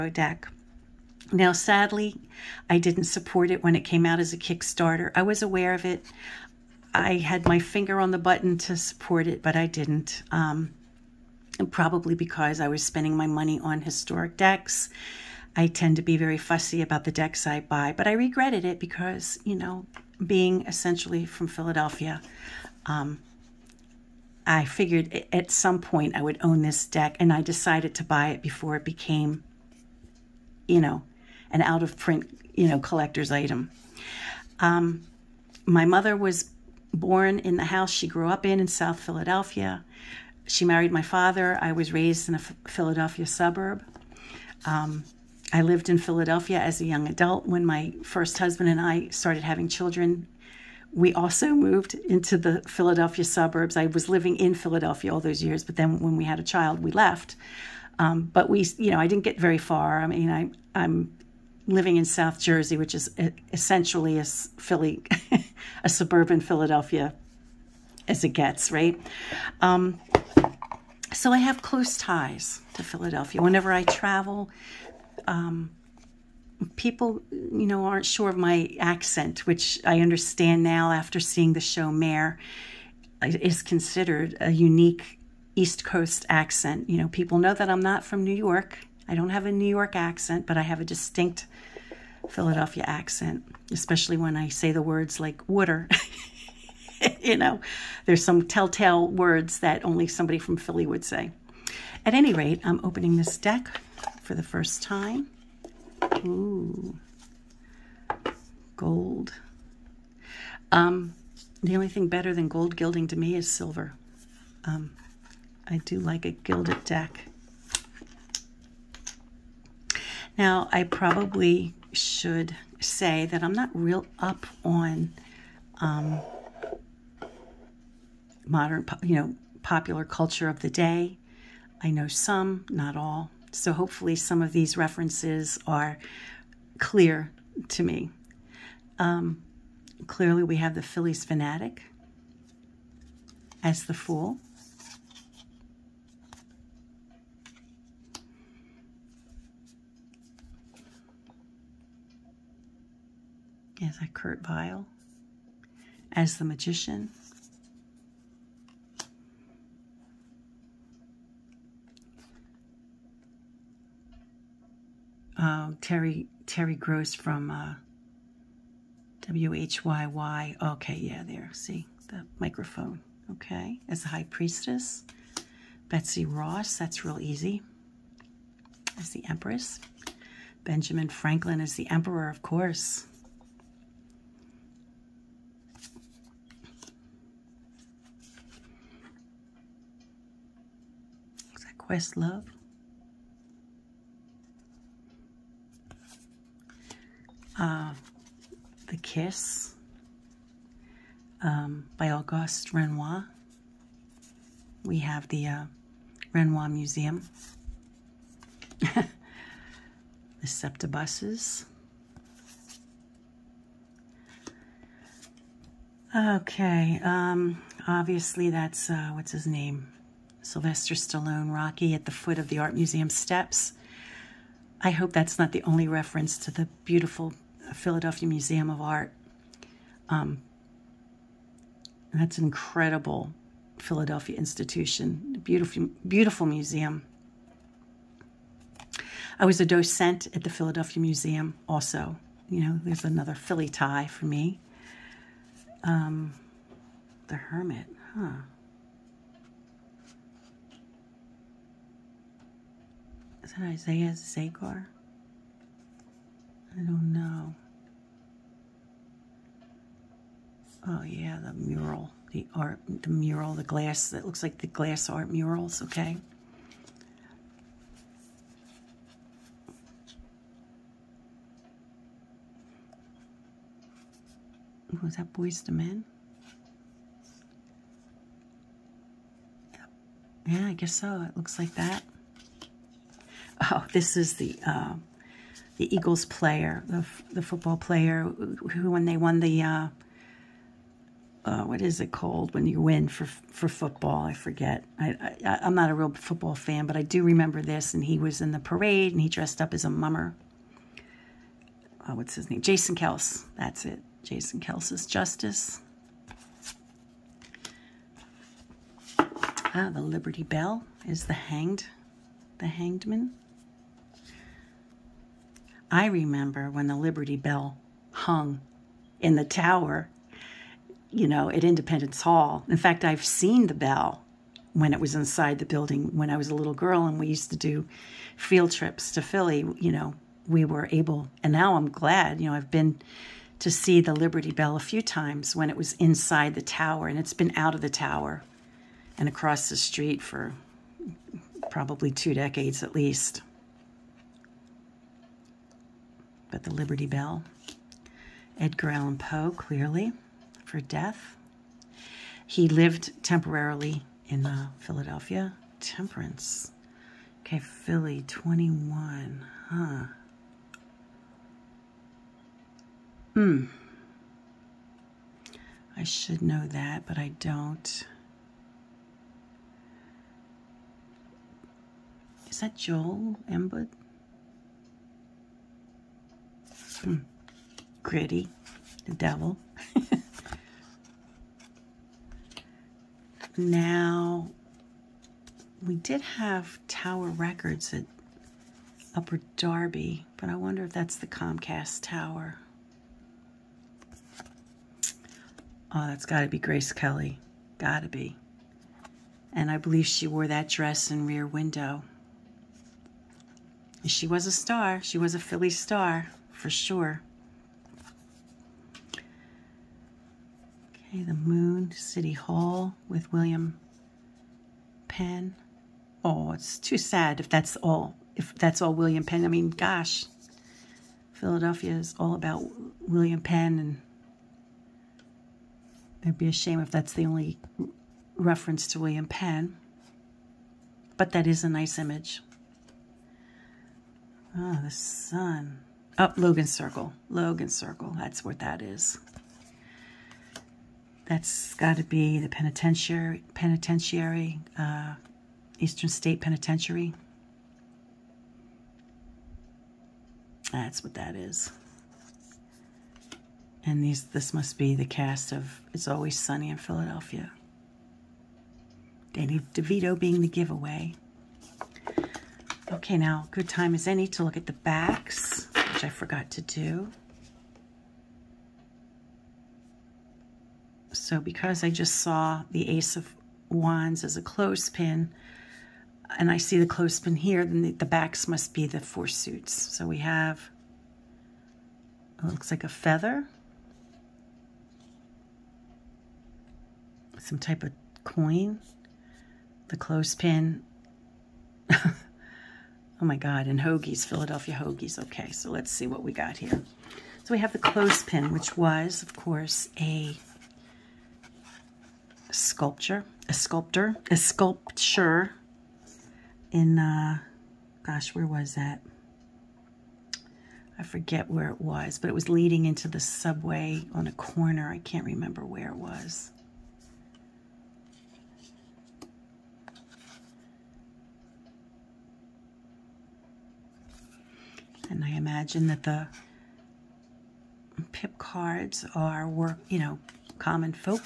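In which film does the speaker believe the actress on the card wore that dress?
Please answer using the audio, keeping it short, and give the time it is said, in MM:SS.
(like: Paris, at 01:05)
Rear Window, at 06:41.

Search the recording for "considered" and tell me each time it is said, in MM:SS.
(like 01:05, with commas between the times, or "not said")
01:23.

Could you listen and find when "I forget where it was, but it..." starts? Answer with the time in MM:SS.
08:30.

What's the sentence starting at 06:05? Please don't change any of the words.
I should know that, but I don't.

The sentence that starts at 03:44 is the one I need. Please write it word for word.
I hope that's not the only reference to the beautiful Philadelphia Museum of Art.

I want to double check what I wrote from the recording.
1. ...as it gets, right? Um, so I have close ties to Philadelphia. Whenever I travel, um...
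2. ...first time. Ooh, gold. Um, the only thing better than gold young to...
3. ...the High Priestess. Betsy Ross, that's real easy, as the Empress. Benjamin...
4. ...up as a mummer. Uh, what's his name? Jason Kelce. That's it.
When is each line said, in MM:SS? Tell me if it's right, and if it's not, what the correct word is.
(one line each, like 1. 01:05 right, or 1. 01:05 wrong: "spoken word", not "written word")
1. 01:08 right
2. 01:44 wrong: "gilding", not "young"
3. 02:54 right
4. 04:59 right.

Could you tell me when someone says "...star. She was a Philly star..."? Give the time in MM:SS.
06:44.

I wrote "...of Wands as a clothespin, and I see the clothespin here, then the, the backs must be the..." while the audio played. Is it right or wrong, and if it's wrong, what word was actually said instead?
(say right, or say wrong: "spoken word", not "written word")
right.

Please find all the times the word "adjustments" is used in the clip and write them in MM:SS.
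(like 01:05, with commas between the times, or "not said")
not said.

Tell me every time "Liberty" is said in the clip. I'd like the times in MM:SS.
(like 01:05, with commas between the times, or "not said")
05:10, 05:16, 05:34, 05:46.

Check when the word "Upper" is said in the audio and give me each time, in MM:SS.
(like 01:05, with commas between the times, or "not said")
06:29.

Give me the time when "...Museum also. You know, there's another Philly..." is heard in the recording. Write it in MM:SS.
04:01.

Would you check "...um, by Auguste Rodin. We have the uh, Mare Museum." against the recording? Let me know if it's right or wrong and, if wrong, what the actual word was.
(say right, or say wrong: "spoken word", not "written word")
wrong: "Rodin", not "Mare".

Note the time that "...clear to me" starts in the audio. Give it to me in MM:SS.
02:16.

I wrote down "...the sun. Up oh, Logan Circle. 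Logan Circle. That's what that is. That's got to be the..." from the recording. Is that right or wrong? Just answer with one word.
right.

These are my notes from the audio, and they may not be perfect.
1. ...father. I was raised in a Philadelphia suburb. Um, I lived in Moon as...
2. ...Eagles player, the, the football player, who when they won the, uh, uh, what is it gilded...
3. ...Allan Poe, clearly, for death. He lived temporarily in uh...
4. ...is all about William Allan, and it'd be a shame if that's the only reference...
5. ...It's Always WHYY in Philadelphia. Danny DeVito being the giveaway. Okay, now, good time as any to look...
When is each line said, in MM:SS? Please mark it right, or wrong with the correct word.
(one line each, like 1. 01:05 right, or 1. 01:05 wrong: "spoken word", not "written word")
1. 00:41 wrong: "Philadelphia", not "Moon"
2. 04:45 wrong: "called", not "gilded"
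3. 05:48 right
4. 07:01 wrong: "Penn", not "Allan"
5. 07:35 wrong: "Sunny", not "WHYY".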